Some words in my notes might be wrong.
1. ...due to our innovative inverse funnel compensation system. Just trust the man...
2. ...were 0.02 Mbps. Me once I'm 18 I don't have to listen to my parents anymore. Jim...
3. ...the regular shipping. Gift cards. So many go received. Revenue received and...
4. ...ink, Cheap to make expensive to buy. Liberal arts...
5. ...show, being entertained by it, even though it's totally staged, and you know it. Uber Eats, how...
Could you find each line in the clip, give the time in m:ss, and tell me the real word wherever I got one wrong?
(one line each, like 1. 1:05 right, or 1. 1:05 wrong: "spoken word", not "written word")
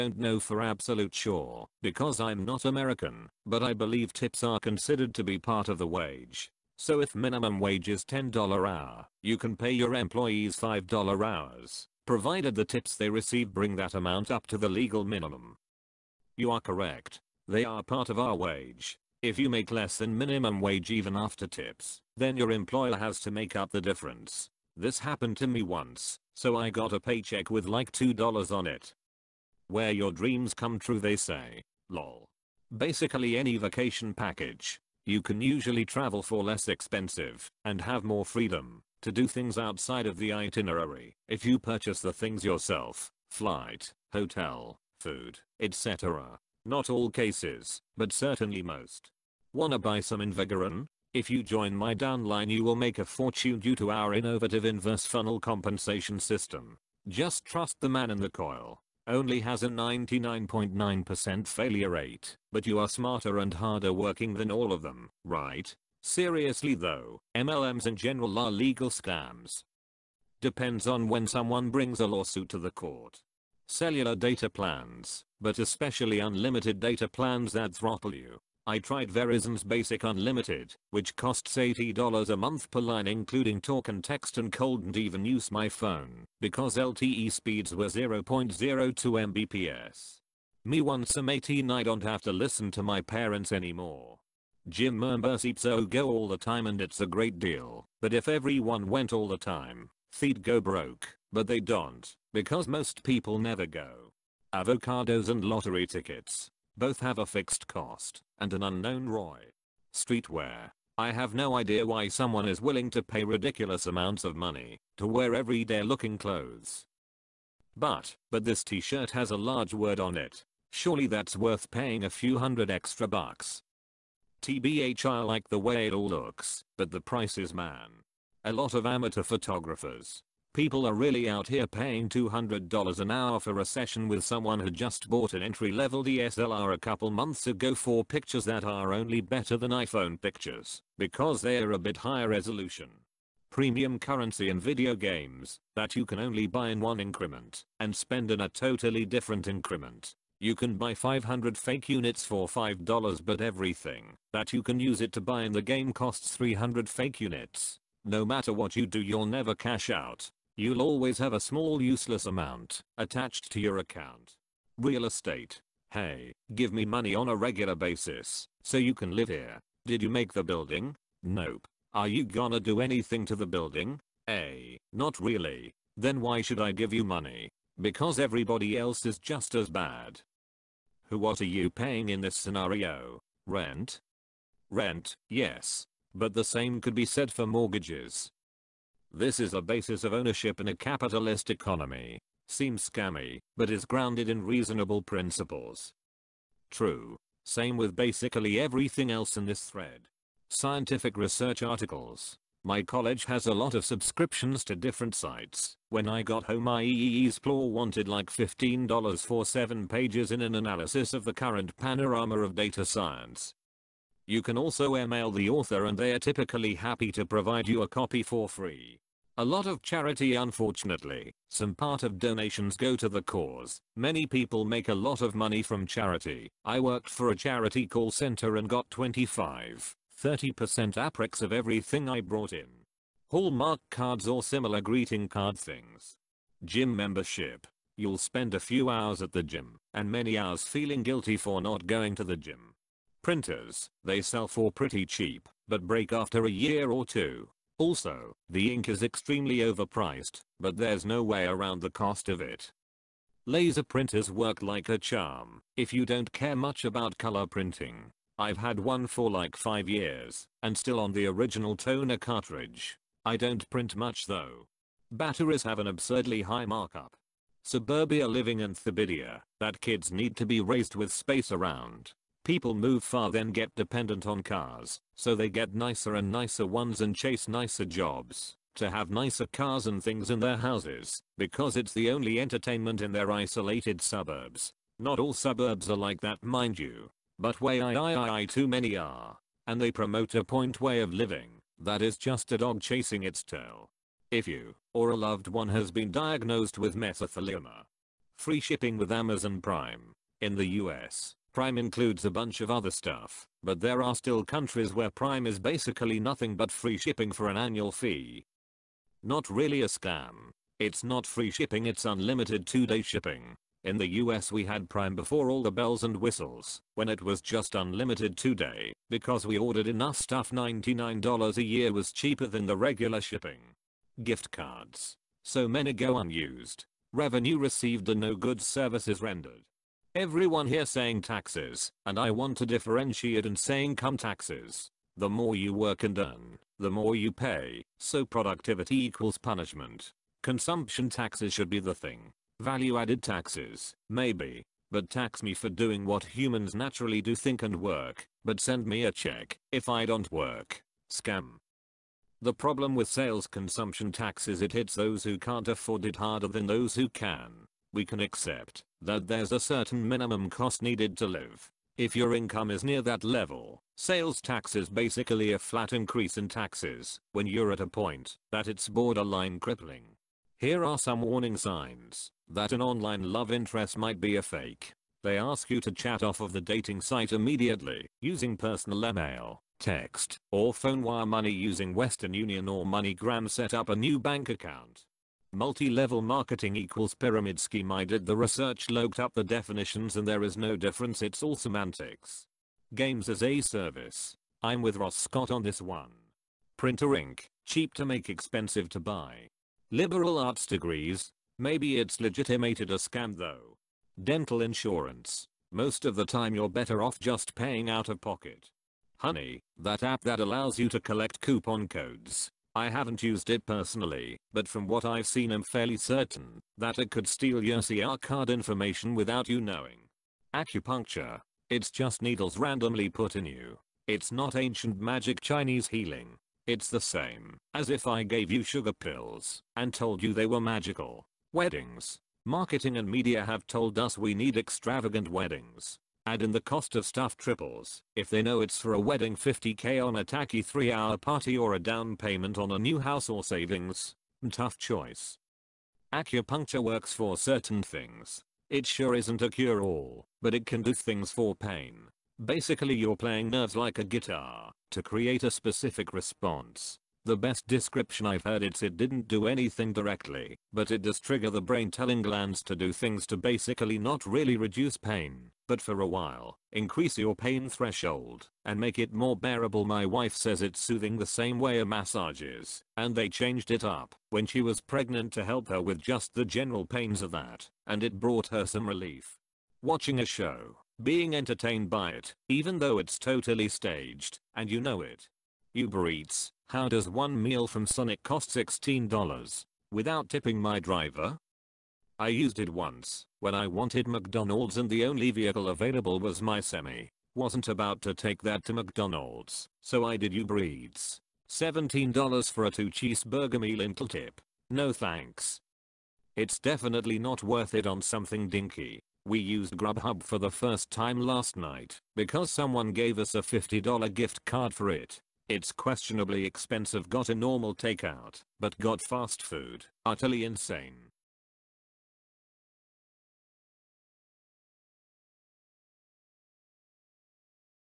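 1. 0:53 right
2. 1:27 right
3. 5:22 wrong: "unused", not "received"
4. 6:37 right
5. 8:00 right.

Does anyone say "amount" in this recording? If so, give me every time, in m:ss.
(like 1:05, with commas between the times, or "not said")
0:13, 1:53, 2:42.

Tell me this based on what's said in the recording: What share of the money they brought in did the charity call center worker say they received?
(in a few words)
25-30%.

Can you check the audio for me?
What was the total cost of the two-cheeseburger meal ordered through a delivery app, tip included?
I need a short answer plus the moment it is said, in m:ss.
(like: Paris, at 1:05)
$17, at 8:21.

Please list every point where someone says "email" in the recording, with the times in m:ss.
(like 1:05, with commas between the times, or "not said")
3:34, 6:19.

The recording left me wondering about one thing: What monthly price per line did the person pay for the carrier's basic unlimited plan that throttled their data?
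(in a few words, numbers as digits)
$80.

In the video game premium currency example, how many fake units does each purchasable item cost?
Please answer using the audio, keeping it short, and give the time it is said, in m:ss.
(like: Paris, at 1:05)
300, at 2:36.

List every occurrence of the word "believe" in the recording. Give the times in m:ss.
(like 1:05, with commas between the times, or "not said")
0:03.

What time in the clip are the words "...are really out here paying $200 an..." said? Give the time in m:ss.
2:10.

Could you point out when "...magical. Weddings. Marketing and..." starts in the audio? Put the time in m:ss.
7:10.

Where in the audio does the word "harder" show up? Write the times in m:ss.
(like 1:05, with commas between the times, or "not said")
1:03, 5:56.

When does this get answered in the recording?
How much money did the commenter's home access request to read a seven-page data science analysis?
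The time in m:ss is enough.
3:28.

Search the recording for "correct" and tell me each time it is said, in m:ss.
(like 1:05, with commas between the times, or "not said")
0:16.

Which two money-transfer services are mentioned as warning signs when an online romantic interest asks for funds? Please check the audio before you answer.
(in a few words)
Western Union or MoneyGram.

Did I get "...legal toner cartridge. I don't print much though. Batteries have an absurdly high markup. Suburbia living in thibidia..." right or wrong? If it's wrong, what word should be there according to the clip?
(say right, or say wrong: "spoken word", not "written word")
wrong: "original", not "legal".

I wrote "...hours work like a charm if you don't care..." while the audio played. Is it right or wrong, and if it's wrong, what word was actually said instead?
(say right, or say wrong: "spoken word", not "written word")
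wrong: "printers", not "hours".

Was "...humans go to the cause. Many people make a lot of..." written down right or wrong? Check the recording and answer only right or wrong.
wrong.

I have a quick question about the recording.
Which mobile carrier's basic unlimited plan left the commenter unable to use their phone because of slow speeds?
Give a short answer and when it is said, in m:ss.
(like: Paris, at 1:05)
Verizon, at 1:19.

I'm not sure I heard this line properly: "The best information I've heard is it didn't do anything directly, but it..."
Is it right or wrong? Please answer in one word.
wrong.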